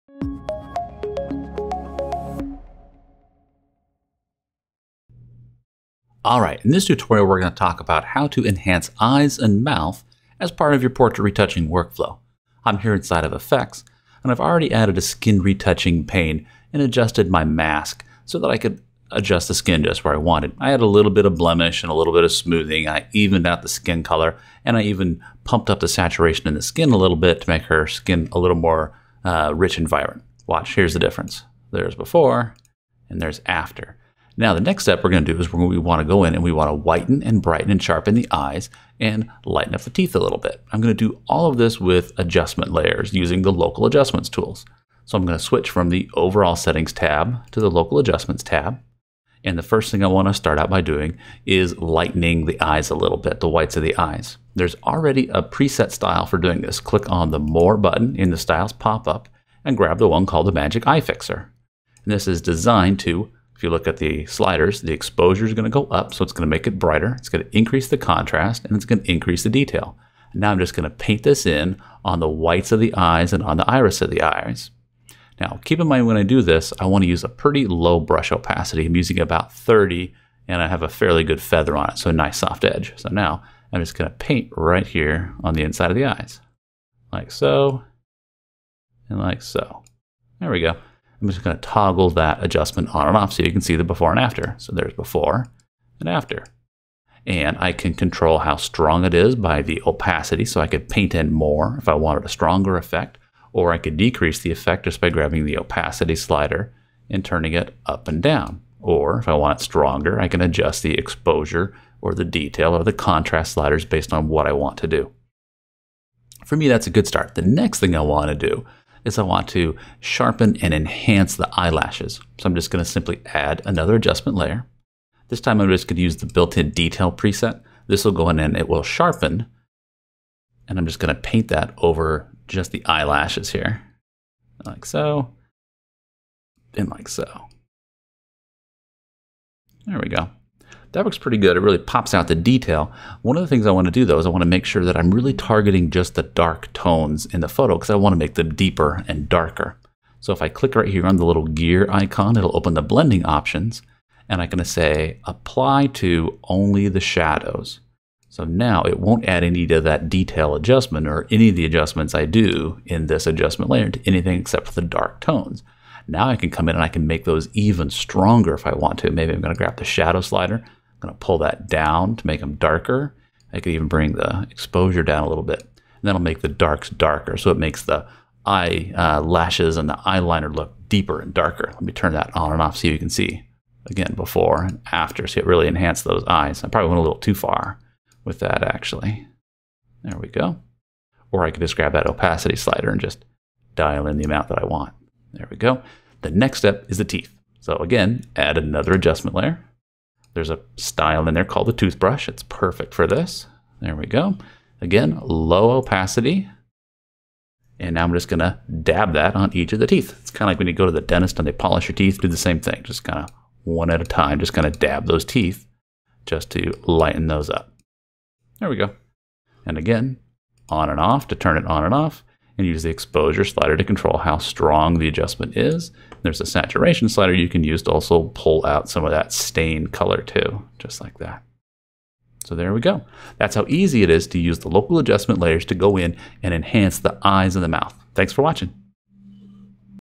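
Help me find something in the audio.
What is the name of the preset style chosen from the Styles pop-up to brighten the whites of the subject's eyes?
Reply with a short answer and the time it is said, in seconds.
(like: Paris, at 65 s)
Magic Eye Fixer, at 60 s.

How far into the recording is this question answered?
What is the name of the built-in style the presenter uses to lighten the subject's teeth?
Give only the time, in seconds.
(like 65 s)
201 s.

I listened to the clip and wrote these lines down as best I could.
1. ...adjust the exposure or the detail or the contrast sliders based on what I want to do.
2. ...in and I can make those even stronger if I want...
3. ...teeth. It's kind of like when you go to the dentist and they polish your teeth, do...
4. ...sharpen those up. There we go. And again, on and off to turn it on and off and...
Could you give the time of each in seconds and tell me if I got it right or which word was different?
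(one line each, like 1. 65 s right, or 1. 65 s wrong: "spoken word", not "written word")
1. 110 s right
2. 166 s right
3. 209 s right
4. 216 s wrong: "lighten", not "sharpen".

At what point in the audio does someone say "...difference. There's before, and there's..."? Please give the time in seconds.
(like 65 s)
30 s.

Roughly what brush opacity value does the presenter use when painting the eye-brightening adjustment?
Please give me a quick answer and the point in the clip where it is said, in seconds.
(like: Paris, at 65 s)
30, at 79 s.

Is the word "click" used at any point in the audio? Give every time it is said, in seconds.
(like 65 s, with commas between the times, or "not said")
56 s, 150 s.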